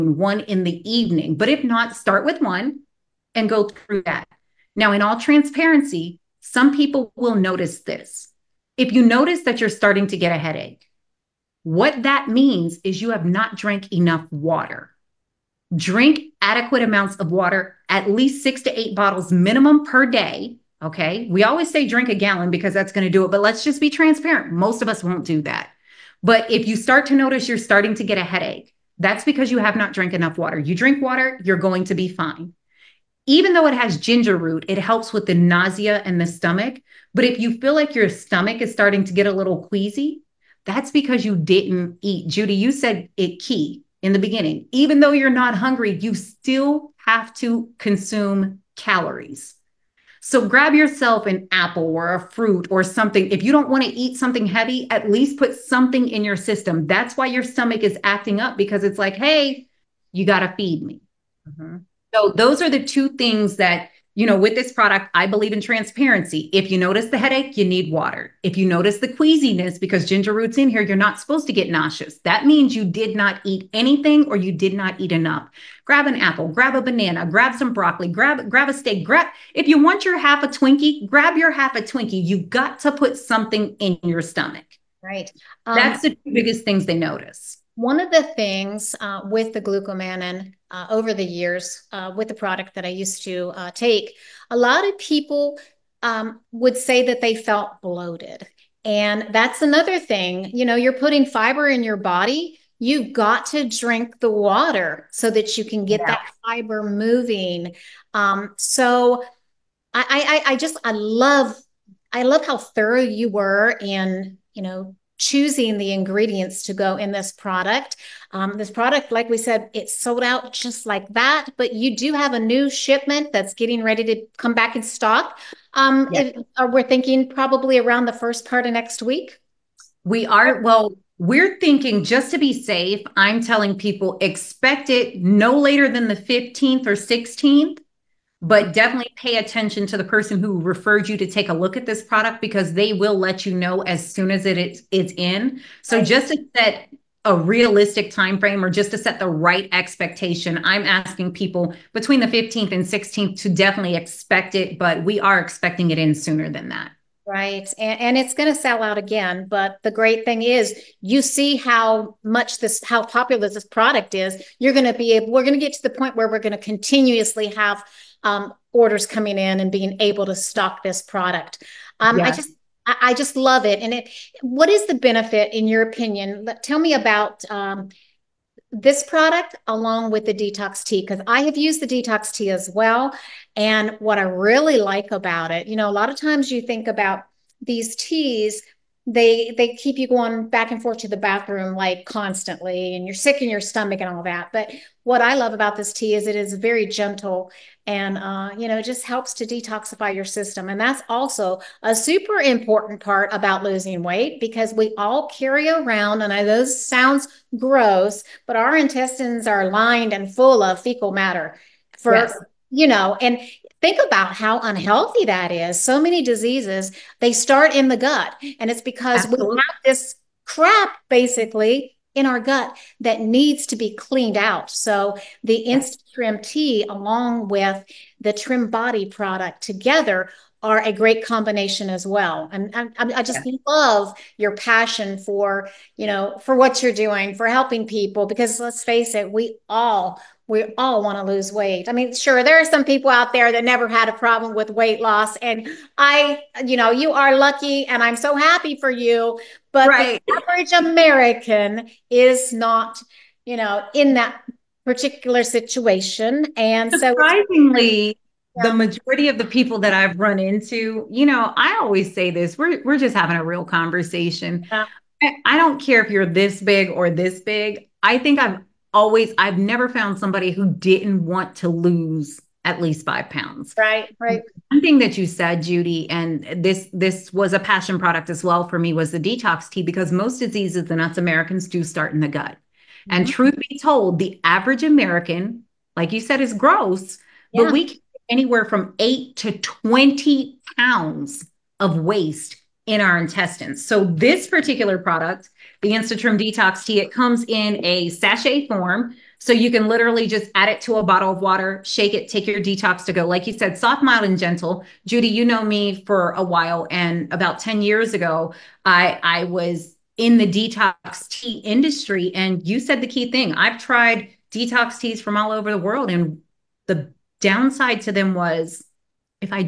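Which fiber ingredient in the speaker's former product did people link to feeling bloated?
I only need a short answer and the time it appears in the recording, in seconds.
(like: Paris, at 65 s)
glucomannan, at 89 s.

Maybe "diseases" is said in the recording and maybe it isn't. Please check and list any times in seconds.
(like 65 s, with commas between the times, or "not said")
216 s, 280 s.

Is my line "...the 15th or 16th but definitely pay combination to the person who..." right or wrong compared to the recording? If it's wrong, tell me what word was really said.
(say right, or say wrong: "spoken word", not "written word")
wrong: "attention", not "combination".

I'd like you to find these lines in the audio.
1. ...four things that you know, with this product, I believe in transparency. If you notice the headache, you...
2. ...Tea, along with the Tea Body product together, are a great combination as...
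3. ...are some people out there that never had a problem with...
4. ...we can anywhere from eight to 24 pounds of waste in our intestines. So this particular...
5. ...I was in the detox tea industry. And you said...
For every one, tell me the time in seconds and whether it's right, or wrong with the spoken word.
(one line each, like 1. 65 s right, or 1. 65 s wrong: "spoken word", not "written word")
1. 62 s wrong: "two", not "four"
2. 226 s wrong: "Trim", not "Tea"
3. 242 s right
4. 287 s wrong: "20", not "24"
5. 309 s right.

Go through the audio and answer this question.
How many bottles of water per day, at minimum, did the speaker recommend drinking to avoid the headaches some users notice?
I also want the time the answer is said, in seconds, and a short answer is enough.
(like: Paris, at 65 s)
6 to 8, at 18 s.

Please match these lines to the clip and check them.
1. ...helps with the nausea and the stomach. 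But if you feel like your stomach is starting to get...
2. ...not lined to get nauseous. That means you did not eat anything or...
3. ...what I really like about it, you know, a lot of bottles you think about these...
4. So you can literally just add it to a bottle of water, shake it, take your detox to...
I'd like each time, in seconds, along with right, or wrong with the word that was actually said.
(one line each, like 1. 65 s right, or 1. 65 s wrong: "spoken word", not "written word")
1. 34 s right
2. 70 s wrong: "supposed", not "lined"
3. 183 s wrong: "times", not "bottles"
4. 299 s right.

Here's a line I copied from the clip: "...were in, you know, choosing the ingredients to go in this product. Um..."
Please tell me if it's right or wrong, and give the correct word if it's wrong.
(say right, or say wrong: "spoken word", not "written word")
right.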